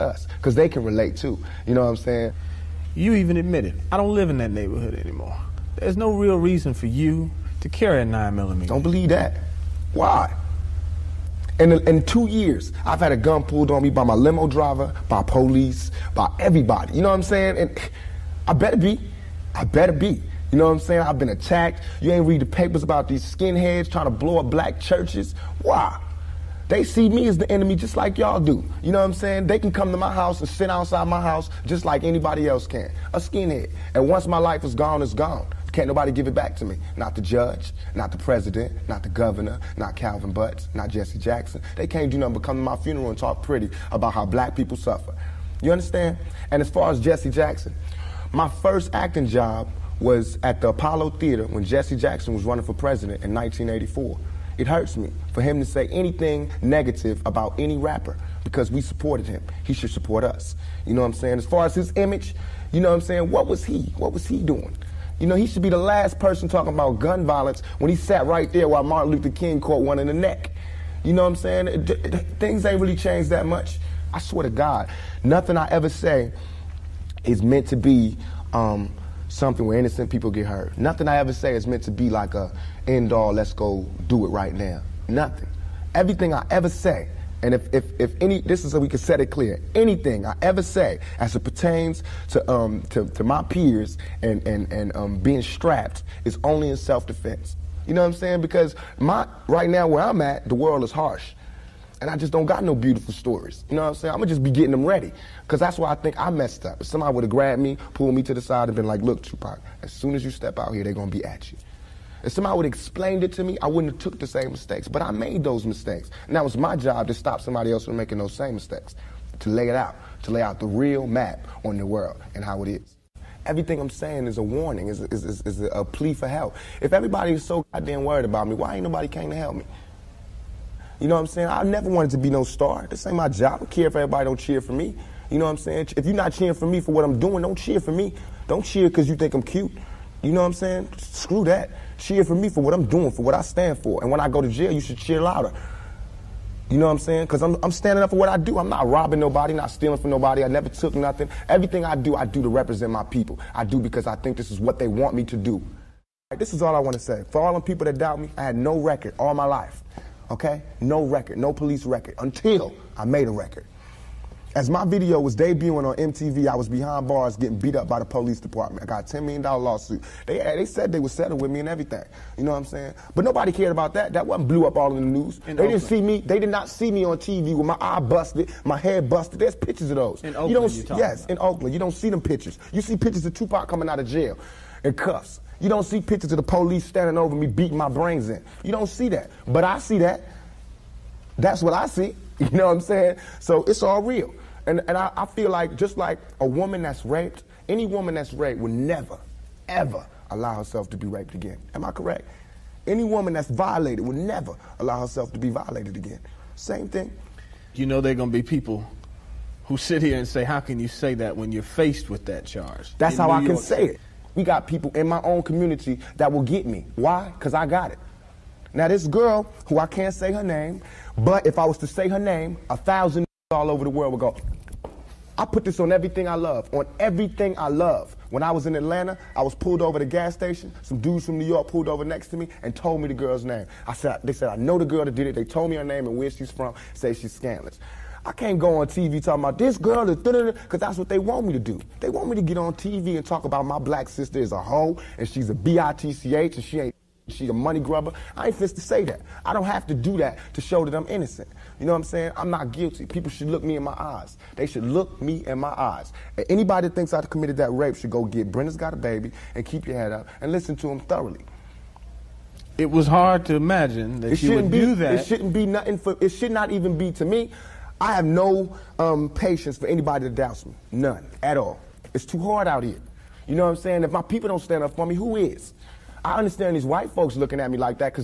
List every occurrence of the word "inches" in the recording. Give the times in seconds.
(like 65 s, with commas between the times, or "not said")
not said.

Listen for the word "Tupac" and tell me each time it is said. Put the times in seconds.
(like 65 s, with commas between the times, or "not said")
109 s, 183 s.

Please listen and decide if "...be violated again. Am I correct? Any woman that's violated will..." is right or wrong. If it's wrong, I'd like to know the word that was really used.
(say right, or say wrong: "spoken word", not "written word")
wrong: "raped", not "violated".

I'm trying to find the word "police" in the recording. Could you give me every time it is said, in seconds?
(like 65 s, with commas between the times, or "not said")
15 s, 161 s, 168 s, 186 s.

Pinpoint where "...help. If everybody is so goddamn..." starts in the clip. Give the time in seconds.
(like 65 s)
126 s.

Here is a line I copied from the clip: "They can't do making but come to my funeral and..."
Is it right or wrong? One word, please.
wrong.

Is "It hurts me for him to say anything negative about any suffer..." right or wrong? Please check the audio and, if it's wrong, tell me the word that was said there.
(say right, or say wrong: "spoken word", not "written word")
wrong: "rapper", not "suffer".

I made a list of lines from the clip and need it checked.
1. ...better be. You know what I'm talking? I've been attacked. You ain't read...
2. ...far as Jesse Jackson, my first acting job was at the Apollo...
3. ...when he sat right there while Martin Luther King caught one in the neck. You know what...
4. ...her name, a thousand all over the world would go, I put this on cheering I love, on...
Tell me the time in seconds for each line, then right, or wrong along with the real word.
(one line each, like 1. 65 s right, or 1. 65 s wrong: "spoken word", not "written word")
1. 19 s wrong: "saying", not "talking"
2. 46 s right
3. 67 s right
4. 222 s wrong: "everything", not "cheering".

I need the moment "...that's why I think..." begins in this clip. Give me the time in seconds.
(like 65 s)
105 s.